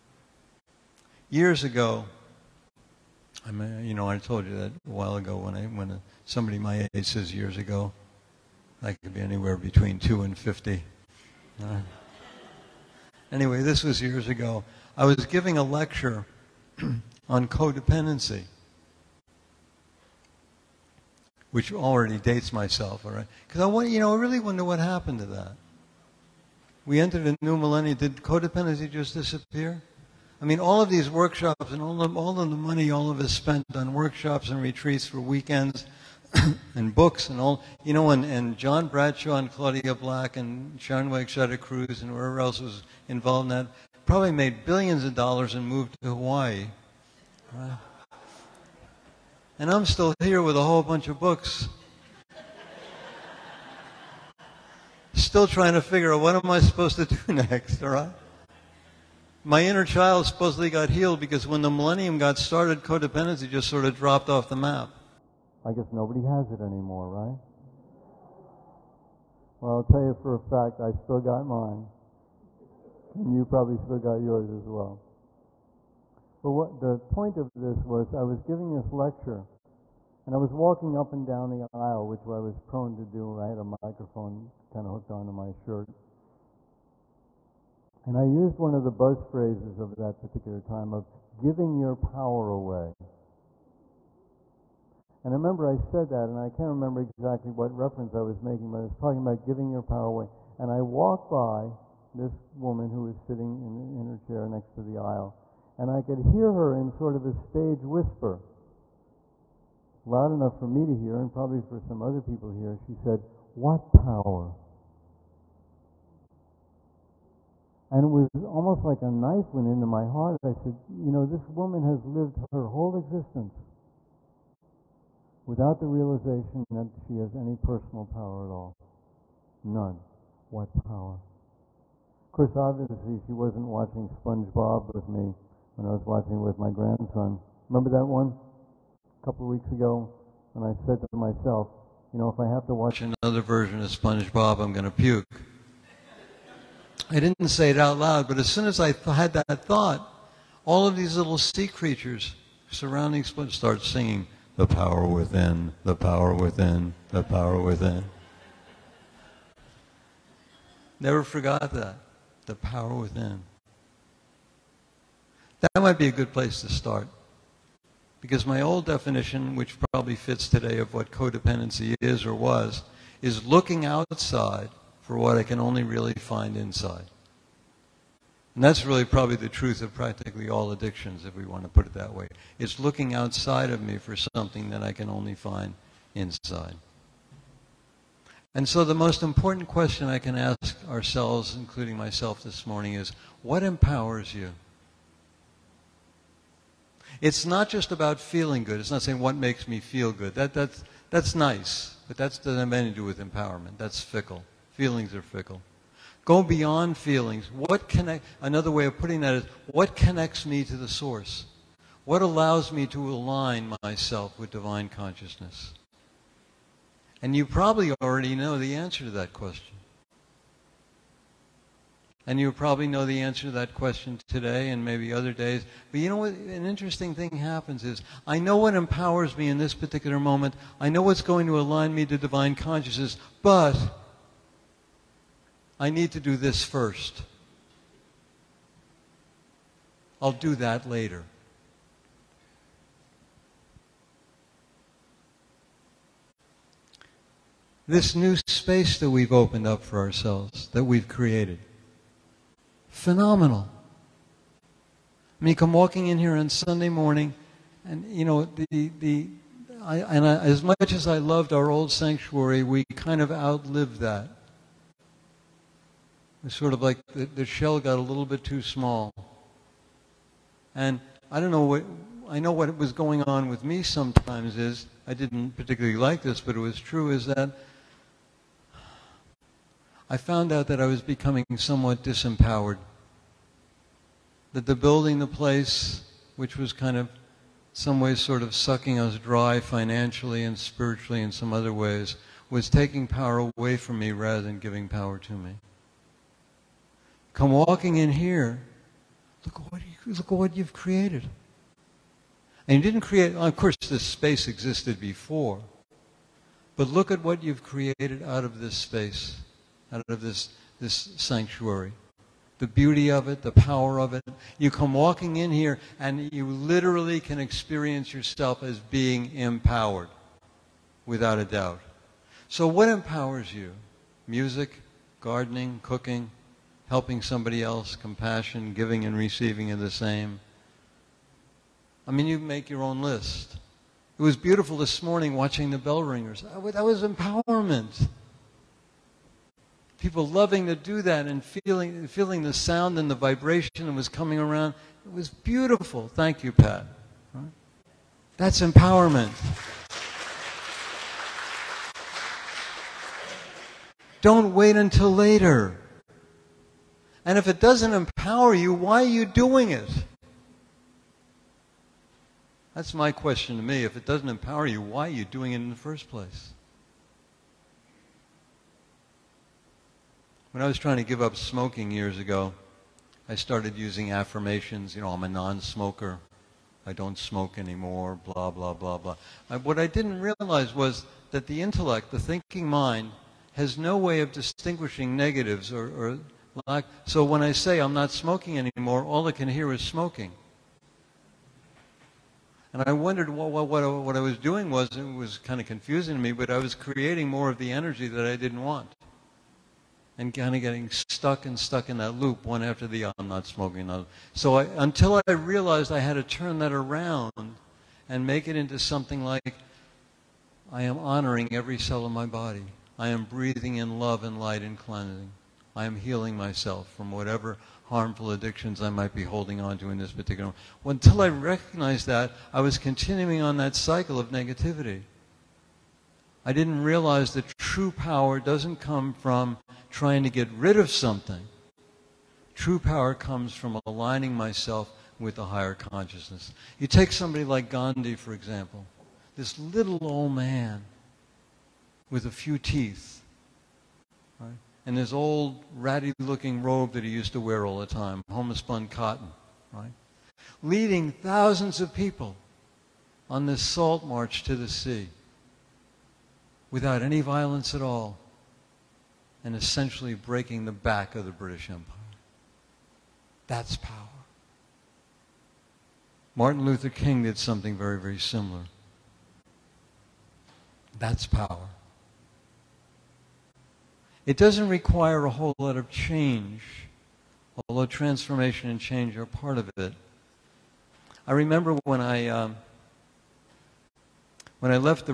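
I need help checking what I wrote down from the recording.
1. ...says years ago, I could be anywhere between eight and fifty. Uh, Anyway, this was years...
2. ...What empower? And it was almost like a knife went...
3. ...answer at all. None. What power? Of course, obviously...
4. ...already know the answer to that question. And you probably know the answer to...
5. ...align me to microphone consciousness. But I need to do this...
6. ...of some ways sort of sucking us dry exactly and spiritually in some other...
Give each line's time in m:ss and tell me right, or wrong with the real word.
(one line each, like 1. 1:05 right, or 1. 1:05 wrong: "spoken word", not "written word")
1. 0:07 wrong: "two", not "eight"
2. 1:53 wrong: "power", not "empower"
3. 2:08 wrong: "power", not "answer"
4. 3:38 right
5. 3:51 wrong: "divine", not "microphone"
6. 4:46 wrong: "financially", not "exactly".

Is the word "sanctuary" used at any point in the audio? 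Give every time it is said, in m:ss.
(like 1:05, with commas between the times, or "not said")
4:21, 5:11.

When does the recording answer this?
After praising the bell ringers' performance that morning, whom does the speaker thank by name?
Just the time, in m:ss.
5:46.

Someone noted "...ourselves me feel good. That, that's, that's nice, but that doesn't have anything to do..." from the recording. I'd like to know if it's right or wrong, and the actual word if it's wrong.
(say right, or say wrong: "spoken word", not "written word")
wrong: "makes", not "ourselves".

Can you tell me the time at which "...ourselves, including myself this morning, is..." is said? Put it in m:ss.
3:10.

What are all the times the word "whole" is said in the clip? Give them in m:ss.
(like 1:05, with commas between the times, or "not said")
0:50, 2:02, 7:55.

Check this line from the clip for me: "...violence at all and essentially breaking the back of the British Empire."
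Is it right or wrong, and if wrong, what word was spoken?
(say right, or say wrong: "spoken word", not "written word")
right.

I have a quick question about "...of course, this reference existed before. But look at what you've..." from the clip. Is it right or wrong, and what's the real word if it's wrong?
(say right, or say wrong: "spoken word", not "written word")
wrong: "space", not "reference".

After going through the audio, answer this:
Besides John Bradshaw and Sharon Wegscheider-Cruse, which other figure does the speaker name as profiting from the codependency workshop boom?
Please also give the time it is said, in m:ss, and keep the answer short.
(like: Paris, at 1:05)
Claudia Black, at 0:39.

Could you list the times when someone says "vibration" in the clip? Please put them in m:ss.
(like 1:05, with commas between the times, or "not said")
5:43.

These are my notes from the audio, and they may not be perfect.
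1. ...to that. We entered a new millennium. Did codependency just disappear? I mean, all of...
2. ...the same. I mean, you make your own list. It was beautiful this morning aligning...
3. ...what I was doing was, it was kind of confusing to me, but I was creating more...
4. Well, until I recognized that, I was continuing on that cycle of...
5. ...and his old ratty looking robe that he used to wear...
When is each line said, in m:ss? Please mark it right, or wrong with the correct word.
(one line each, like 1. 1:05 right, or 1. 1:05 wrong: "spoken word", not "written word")
1. 0:25 right
2. 5:29 wrong: "watching", not "aligning"
3. 6:34 right
4. 7:00 right
5. 7:24 right.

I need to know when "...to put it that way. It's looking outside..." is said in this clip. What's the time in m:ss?
3:01.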